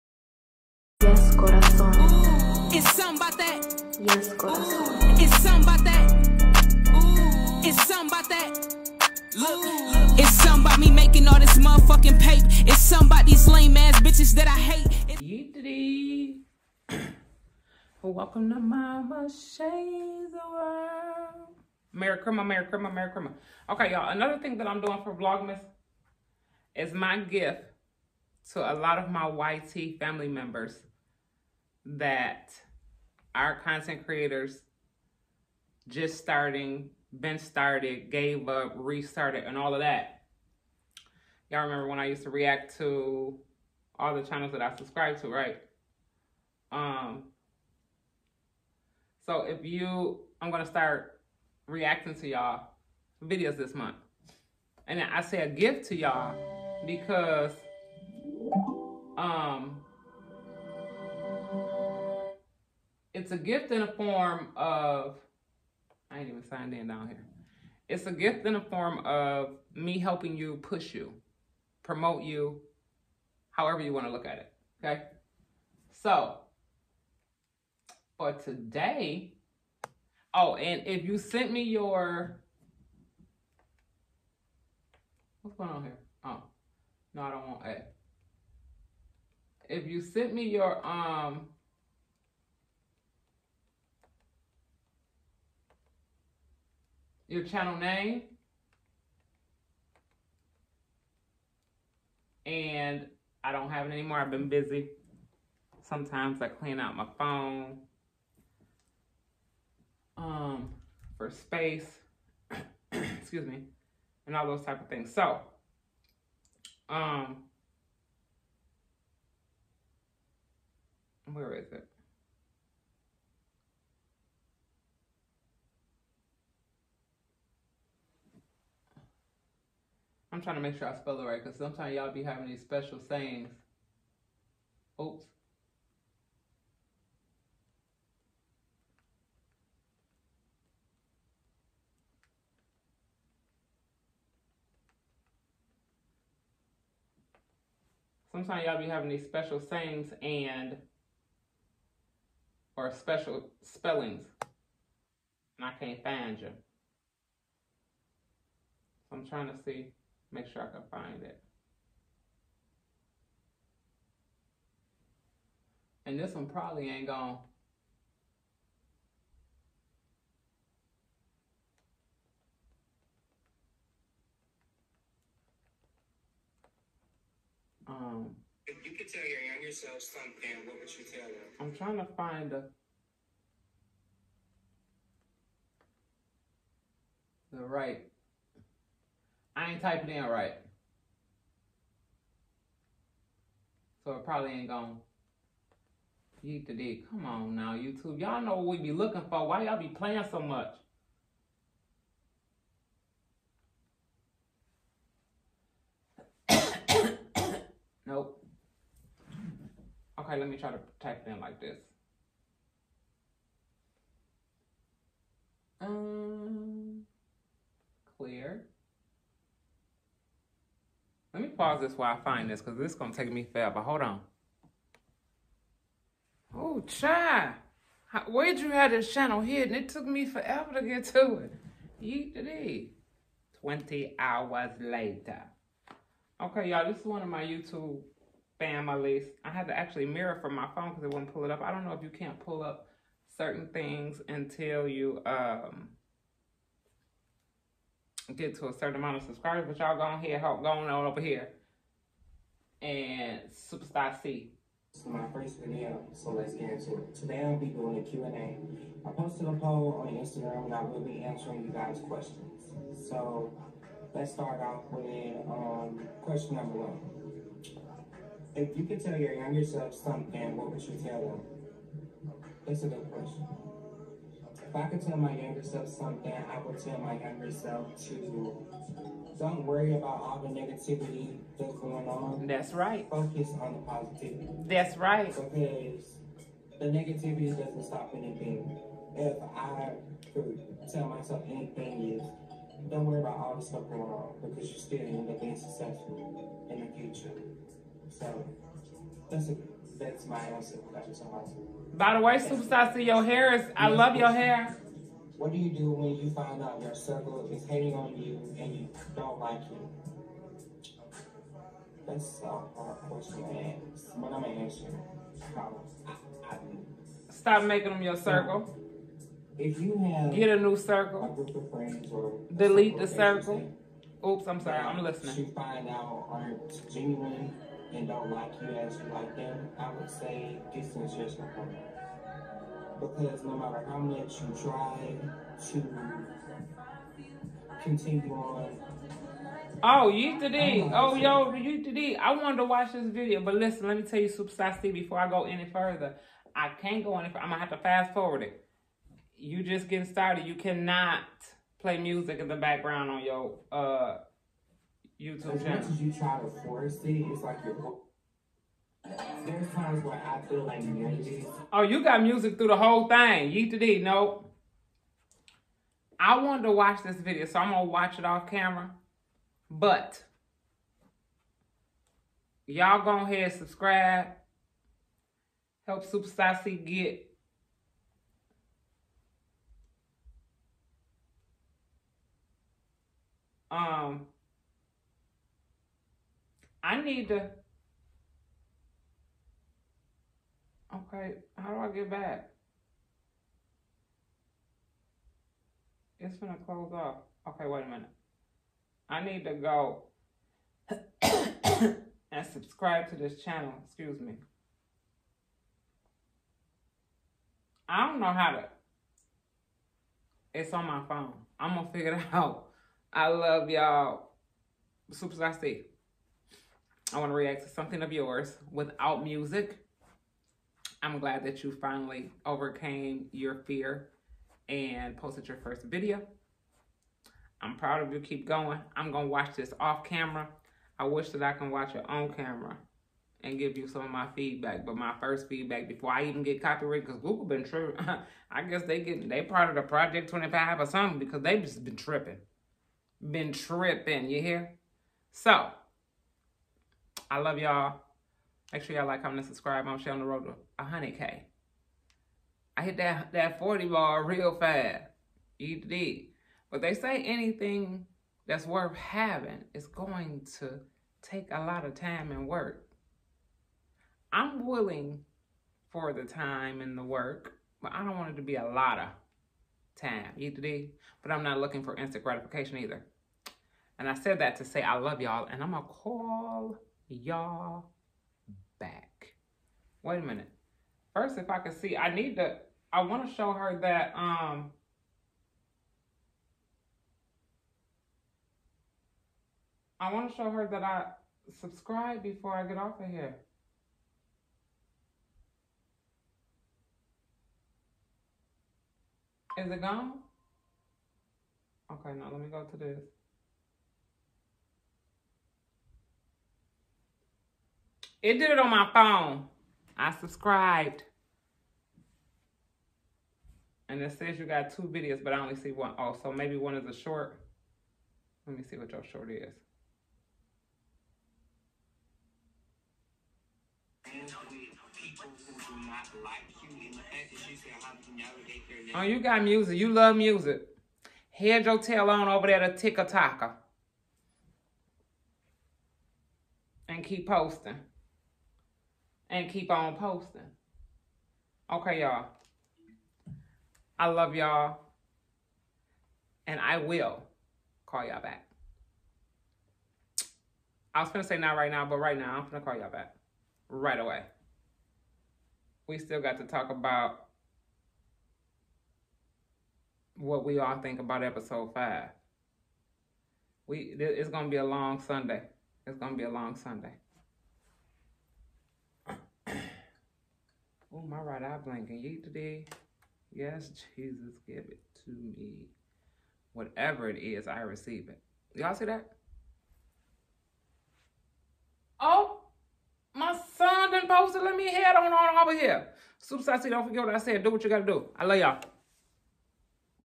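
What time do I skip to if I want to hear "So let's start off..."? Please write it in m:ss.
4:23.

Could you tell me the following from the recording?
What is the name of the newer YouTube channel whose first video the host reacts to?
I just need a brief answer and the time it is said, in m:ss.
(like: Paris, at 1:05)
Superstar C, at 4:13.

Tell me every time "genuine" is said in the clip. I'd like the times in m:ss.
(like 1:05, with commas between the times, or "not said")
5:26.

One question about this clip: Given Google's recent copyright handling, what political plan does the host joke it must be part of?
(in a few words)
Project 25.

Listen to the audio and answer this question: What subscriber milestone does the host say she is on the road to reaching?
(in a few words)
100K.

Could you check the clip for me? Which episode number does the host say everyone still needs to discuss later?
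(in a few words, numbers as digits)
5.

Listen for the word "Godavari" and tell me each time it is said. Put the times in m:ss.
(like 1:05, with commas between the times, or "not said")
not said.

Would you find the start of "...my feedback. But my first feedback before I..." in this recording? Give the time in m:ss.
7:14.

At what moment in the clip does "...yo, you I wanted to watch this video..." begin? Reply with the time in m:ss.
5:41.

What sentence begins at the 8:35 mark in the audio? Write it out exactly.
Oh, so maybe one is a short.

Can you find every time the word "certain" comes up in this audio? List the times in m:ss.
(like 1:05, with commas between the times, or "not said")
4:03, 4:08.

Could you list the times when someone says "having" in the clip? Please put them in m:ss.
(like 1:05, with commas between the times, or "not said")
2:12, 2:28, 7:38.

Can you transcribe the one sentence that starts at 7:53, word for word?
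And I said that to say I love y'all, and I'm going to call y'all back.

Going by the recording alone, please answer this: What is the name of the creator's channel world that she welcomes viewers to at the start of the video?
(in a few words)
Mama Shay's World.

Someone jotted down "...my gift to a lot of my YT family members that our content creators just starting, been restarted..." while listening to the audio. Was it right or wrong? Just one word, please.
wrong.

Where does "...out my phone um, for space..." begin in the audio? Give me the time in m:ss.
1:46.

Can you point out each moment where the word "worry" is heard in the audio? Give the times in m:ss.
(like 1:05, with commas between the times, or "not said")
4:39, 4:53.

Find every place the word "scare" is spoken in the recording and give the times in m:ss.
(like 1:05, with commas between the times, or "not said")
not said.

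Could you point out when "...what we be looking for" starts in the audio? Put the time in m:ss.
3:18.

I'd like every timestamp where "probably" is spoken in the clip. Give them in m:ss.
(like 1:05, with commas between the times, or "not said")
2:46, 3:14.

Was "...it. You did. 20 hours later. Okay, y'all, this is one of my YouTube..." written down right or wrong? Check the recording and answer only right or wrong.
right.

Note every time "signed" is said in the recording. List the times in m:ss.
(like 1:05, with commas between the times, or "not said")
1:06.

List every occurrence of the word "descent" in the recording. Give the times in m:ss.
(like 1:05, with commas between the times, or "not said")
not said.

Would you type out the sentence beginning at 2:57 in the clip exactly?
Um, if you could tell your younger self something, what would you tell them?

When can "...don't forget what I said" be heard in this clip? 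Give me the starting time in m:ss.
9:46.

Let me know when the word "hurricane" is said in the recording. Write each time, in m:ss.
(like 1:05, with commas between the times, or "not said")
not said.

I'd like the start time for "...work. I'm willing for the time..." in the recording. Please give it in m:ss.
7:42.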